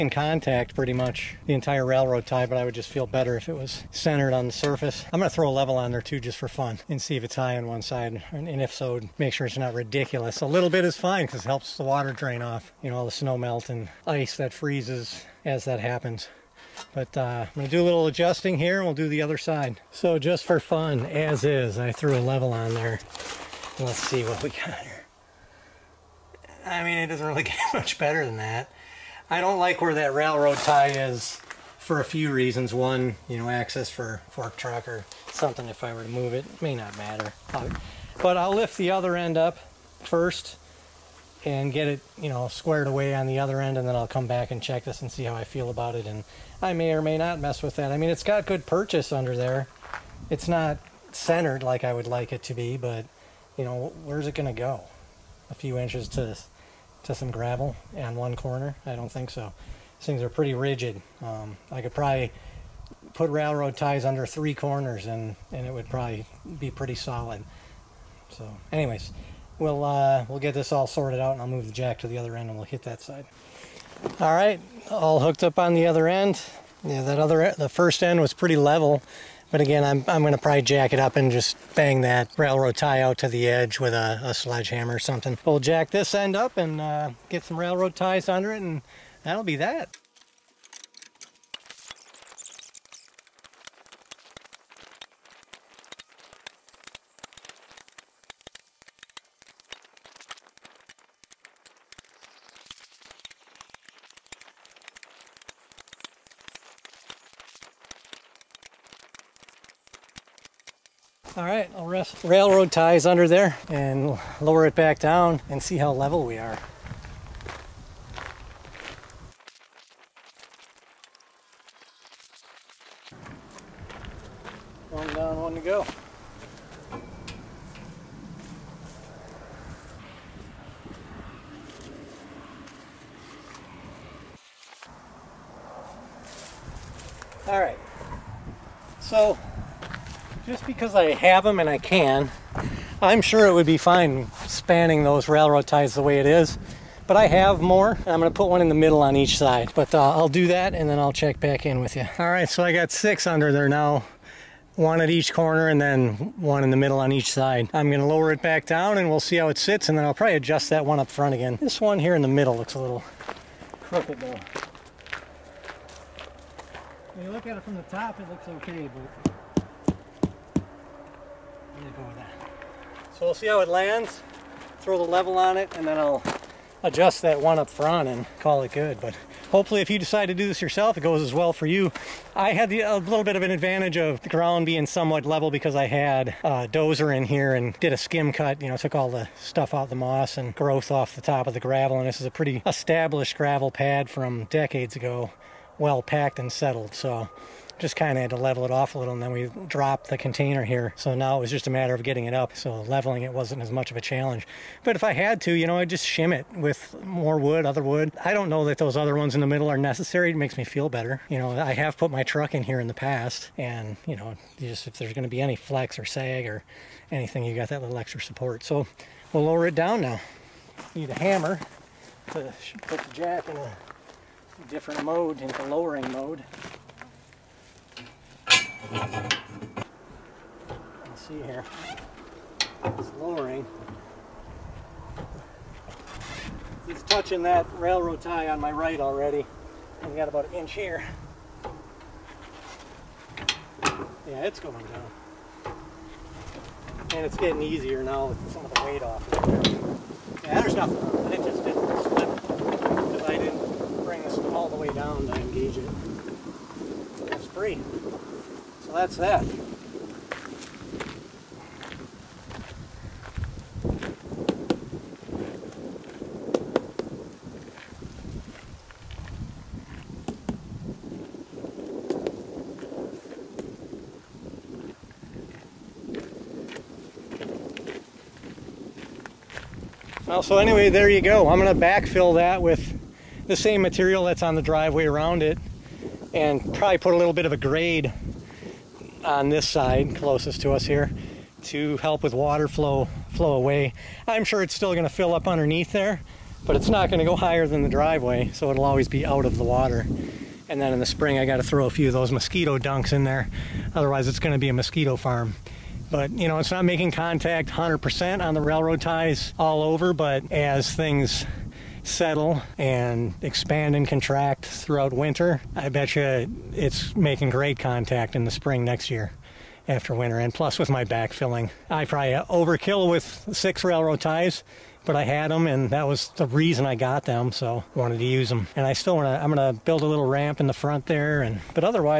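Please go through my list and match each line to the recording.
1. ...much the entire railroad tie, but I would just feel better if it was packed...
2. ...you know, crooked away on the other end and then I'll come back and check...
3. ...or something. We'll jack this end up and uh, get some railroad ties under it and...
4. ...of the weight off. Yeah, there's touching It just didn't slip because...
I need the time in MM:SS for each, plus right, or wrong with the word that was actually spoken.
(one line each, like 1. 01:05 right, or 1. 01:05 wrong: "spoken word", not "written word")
1. 00:00 wrong: "centered", not "packed"
2. 00:42 wrong: "squared", not "crooked"
3. 01:24 right
4. 04:08 wrong: "nothing", not "touching".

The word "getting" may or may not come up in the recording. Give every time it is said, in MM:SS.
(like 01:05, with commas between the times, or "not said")
03:22, 04:07.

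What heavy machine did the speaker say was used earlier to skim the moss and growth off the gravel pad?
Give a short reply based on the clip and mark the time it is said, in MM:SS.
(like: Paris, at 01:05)
dozer, at 03:06.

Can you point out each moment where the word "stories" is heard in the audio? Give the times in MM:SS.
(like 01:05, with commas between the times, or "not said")
not said.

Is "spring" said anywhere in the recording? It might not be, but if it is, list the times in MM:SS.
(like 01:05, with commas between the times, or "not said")
05:01, 05:18.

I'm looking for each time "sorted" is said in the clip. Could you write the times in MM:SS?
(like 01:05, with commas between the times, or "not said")
01:10.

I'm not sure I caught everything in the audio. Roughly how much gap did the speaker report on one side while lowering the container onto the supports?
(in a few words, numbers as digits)
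1 inch.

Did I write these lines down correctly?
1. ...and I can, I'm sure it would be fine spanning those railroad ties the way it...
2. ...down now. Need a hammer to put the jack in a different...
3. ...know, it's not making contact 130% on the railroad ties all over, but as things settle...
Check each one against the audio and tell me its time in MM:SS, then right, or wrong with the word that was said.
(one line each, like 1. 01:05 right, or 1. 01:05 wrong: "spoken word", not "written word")
1. 02:21 right
2. 03:39 right
3. 05:06 wrong: "100", not "130".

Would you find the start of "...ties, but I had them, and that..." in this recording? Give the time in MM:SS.
05:24.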